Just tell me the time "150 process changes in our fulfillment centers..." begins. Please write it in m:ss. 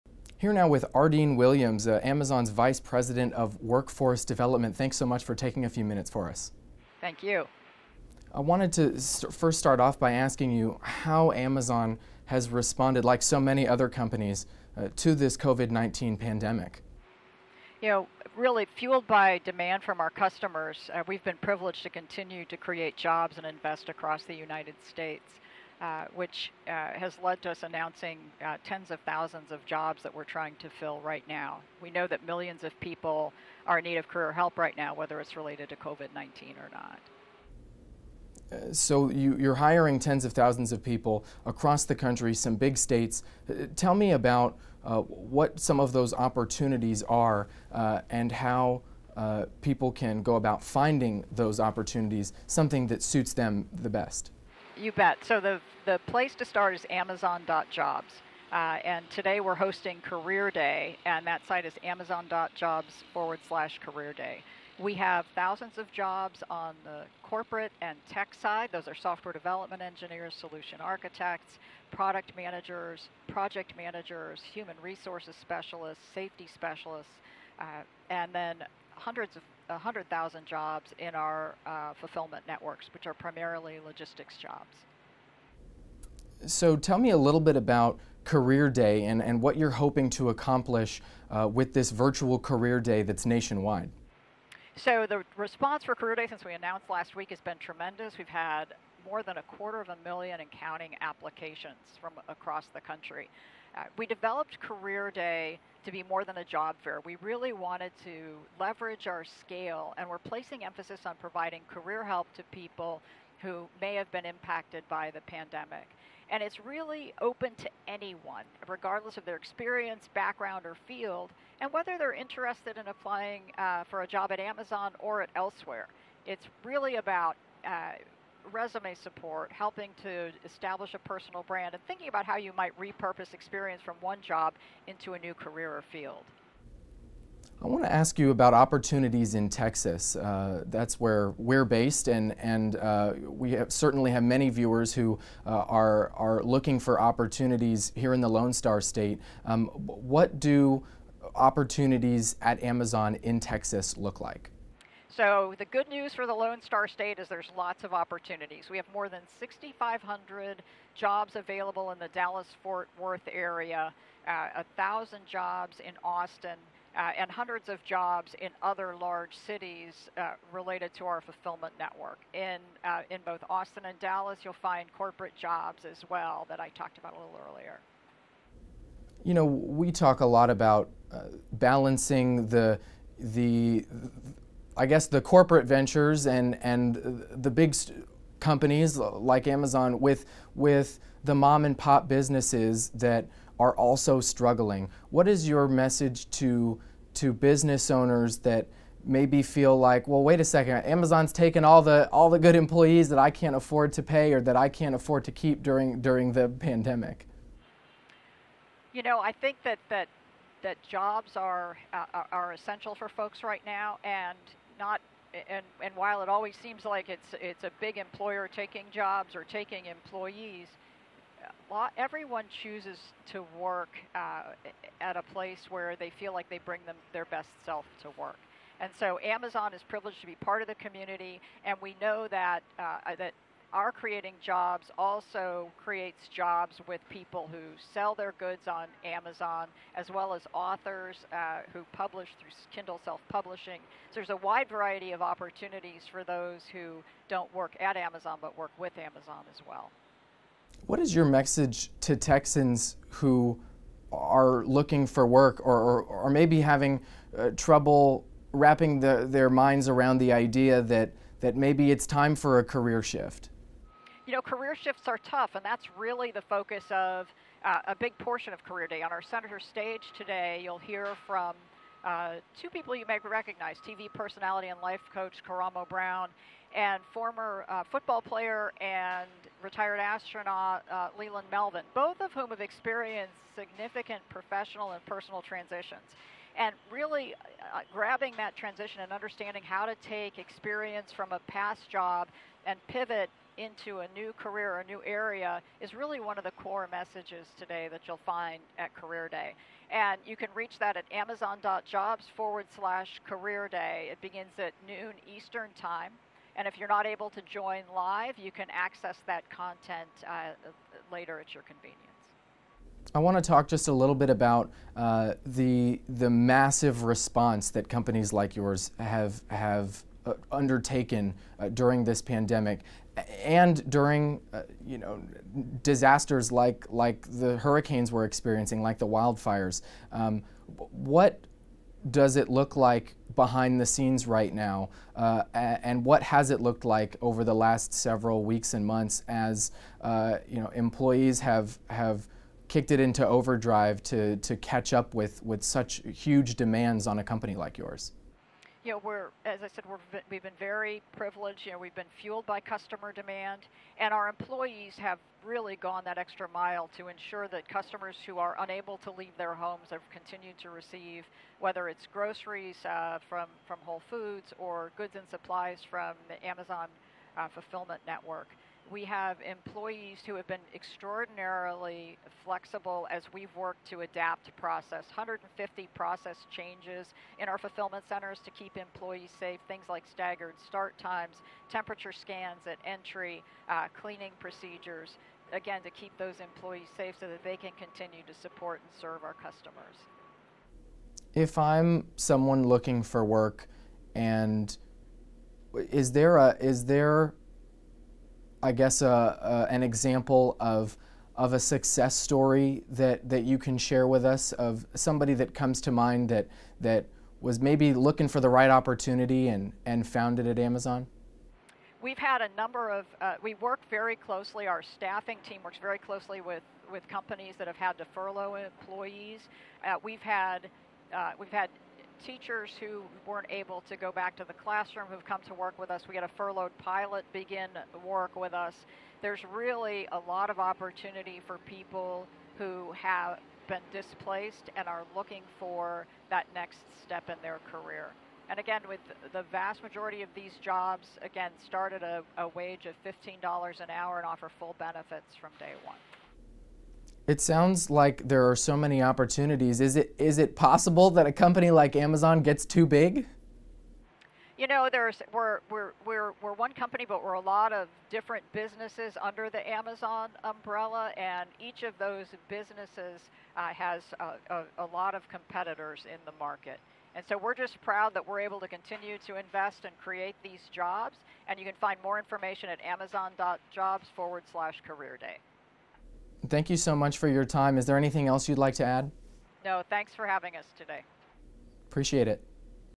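6:15.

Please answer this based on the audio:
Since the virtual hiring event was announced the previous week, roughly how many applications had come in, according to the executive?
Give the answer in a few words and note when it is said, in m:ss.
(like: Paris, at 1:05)
more than a quarter of a million, at 1:39.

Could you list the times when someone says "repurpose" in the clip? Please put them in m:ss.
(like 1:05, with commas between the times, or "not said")
2:12.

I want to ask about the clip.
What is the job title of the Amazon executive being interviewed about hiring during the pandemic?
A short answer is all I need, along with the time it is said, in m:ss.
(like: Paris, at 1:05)
Vice President of Workforce Development, at 0:02.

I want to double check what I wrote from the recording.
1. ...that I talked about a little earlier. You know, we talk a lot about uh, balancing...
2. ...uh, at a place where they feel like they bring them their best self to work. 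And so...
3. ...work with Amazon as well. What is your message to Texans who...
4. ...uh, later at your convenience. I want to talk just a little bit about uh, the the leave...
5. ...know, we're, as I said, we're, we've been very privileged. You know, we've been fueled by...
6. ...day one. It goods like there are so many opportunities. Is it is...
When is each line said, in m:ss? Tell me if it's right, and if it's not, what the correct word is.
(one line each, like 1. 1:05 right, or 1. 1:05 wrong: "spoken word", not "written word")
1. 2:56 right
2. 3:44 right
3. 4:08 right
4. 5:10 wrong: "massive", not "leave"
5. 5:48 right
6. 7:25 wrong: "sounds", not "goods".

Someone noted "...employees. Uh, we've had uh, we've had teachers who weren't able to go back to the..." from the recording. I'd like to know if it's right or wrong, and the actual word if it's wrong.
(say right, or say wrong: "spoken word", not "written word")
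right.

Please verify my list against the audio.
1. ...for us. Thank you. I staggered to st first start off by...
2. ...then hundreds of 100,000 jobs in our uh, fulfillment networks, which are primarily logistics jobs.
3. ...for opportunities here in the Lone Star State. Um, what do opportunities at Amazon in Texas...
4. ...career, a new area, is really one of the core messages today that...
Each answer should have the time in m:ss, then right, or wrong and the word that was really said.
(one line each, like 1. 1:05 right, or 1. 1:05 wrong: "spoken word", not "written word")
1. 0:06 wrong: "wanted", not "staggered"
2. 1:18 right
3. 2:26 right
4. 4:54 right.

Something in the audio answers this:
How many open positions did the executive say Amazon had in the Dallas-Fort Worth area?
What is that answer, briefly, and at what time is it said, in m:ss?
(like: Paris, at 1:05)
6,500, at 2:39.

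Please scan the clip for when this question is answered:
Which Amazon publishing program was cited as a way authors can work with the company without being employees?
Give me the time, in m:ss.
4:02.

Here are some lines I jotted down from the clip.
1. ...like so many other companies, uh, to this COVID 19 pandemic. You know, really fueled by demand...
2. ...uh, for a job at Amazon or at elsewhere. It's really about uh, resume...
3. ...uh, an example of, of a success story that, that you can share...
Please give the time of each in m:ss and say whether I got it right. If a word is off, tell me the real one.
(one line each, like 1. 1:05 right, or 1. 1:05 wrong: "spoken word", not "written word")
1. 0:13 right
2. 2:03 right
3. 6:39 right.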